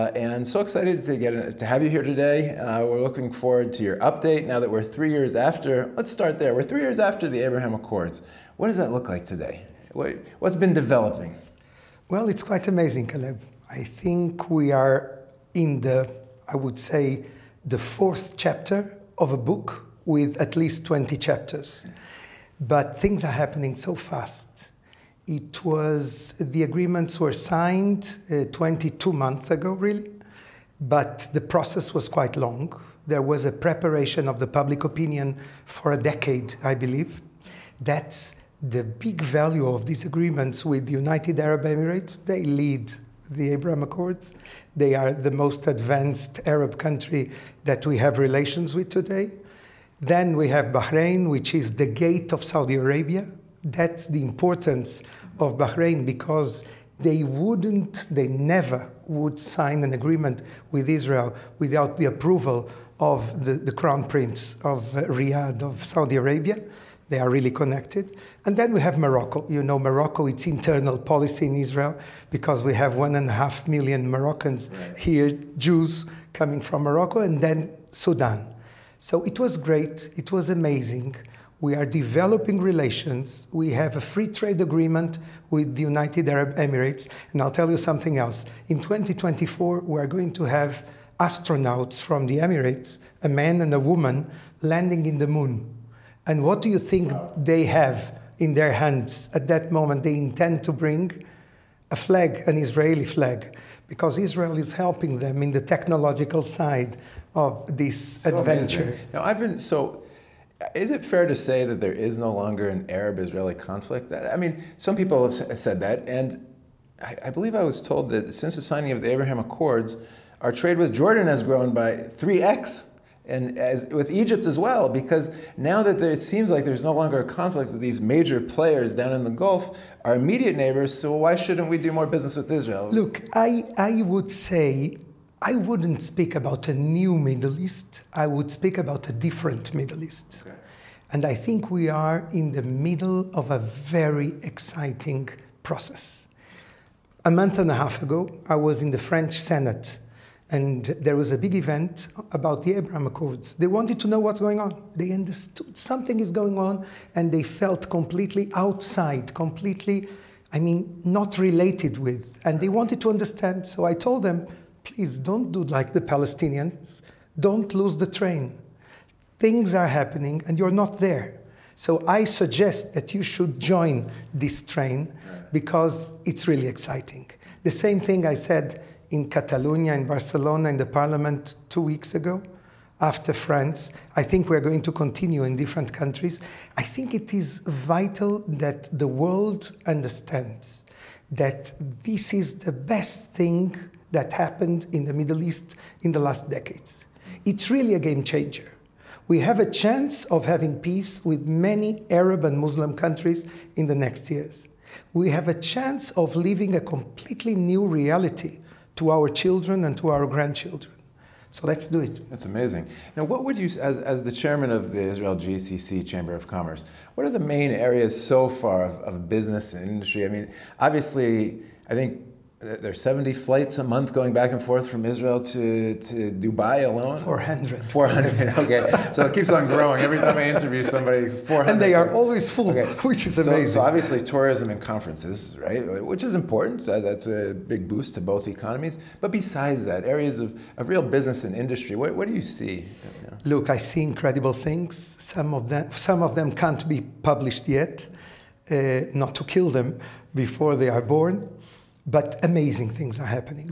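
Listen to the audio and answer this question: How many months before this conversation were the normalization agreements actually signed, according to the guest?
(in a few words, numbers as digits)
22.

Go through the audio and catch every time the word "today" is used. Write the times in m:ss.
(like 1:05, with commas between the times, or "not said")
0:02, 0:09, 0:48.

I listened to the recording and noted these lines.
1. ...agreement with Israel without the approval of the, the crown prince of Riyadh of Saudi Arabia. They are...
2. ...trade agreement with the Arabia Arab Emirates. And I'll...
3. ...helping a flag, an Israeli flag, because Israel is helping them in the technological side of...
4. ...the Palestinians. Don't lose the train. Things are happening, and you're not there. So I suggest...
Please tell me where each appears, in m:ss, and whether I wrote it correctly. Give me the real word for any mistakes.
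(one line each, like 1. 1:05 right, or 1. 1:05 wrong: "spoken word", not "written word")
1. 0:59 right
2. 1:24 wrong: "United", not "Arabia"
3. 1:40 wrong: "bring", not "helping"
4. 2:45 right.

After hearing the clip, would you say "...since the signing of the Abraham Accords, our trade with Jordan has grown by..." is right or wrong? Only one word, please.
right.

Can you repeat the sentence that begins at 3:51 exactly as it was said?
And they are always full, okay.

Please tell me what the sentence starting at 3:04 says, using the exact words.
I think we're going to continue in different countries.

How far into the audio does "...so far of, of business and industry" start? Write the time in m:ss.
3:38.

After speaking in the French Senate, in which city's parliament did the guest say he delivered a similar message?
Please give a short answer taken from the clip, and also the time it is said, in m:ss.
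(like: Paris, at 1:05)
Barcelona, at 3:00.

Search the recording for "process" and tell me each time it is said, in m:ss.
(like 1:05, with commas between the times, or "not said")
0:31, 2:25.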